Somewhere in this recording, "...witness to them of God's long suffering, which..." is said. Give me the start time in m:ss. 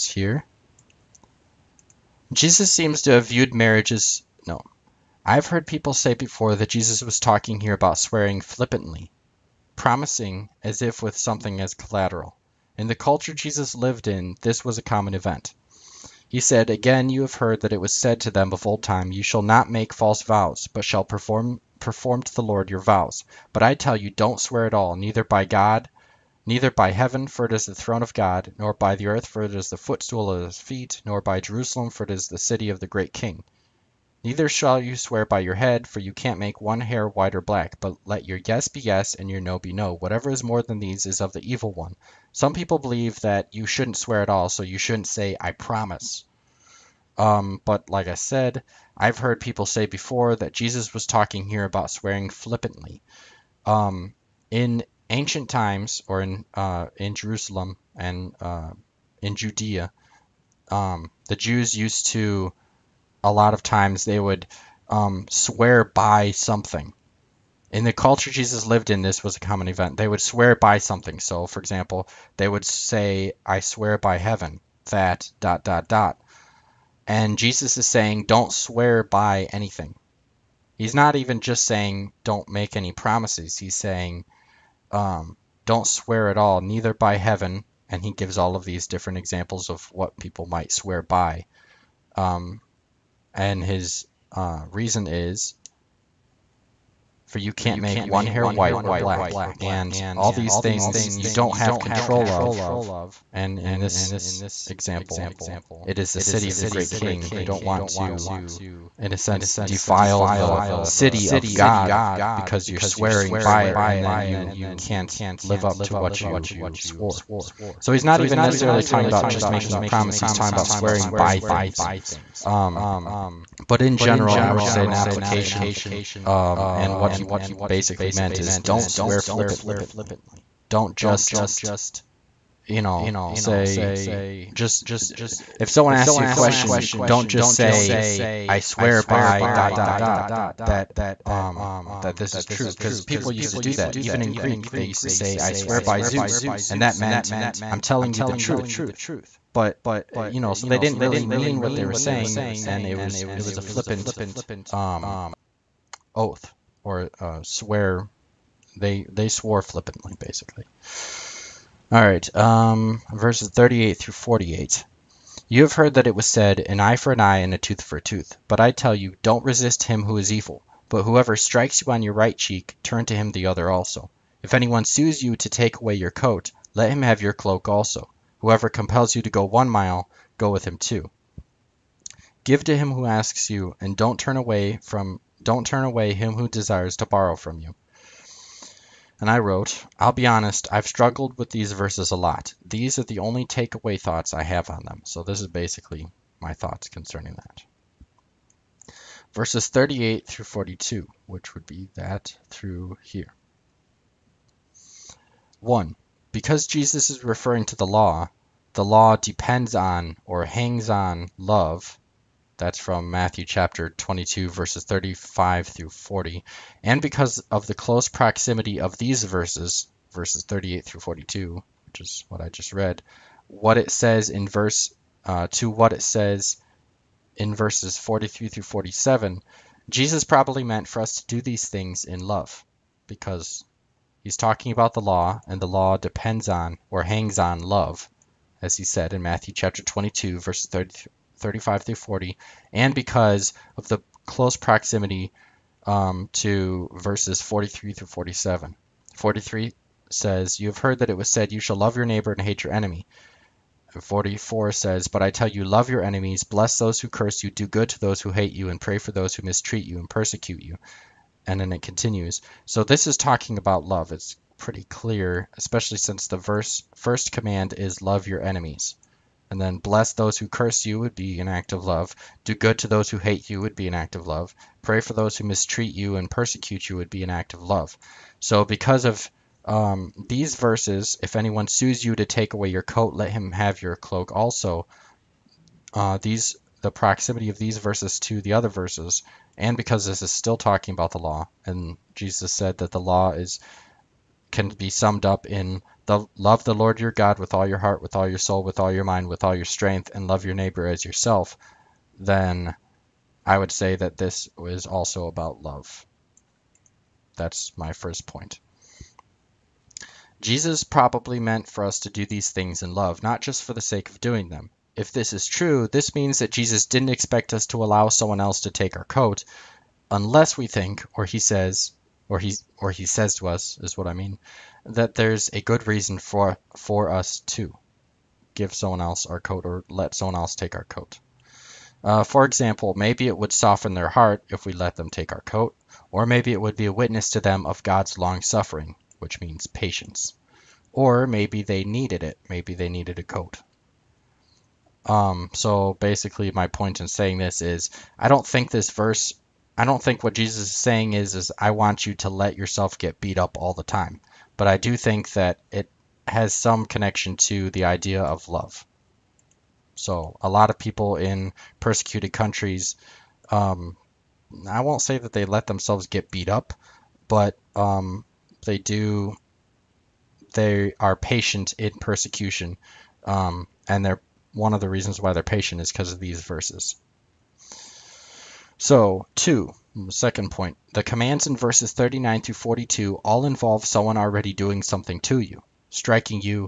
5:36.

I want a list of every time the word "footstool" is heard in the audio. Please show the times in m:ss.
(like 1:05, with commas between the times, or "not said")
0:29.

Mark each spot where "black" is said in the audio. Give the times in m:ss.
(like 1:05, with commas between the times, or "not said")
0:37, 1:38.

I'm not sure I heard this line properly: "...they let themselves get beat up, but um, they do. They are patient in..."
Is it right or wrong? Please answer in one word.
right.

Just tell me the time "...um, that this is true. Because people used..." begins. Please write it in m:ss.
2:21.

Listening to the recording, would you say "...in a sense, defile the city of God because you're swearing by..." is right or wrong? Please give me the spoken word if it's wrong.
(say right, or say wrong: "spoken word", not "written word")
right.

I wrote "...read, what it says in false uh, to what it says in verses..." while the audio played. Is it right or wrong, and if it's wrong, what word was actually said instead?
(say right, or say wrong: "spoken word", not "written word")
wrong: "verse", not "false".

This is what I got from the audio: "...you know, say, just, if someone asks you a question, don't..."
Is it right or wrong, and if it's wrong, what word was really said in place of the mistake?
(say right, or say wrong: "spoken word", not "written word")
right.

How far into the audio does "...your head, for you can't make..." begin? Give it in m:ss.
0:35.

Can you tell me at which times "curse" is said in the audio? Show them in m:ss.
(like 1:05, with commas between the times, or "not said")
4:17, 4:30.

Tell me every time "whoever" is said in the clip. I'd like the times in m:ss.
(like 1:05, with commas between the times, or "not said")
2:51, 2:58.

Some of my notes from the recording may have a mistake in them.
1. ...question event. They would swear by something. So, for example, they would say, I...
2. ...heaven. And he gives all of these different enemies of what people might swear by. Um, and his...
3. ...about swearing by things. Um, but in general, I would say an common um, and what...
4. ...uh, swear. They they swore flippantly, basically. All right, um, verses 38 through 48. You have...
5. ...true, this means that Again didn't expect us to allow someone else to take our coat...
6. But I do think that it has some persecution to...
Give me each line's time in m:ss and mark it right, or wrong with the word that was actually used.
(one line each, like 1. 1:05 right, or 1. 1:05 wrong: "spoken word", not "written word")
1. 1:09 wrong: "common", not "question"
2. 1:27 wrong: "examples", not "enemies"
3. 2:00 wrong: "application", not "common"
4. 2:37 right
5. 5:15 wrong: "Jesus", not "Again"
6. 5:54 wrong: "connection", not "persecution".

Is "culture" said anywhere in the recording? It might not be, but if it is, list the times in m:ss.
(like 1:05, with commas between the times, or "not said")
0:12, 1:07.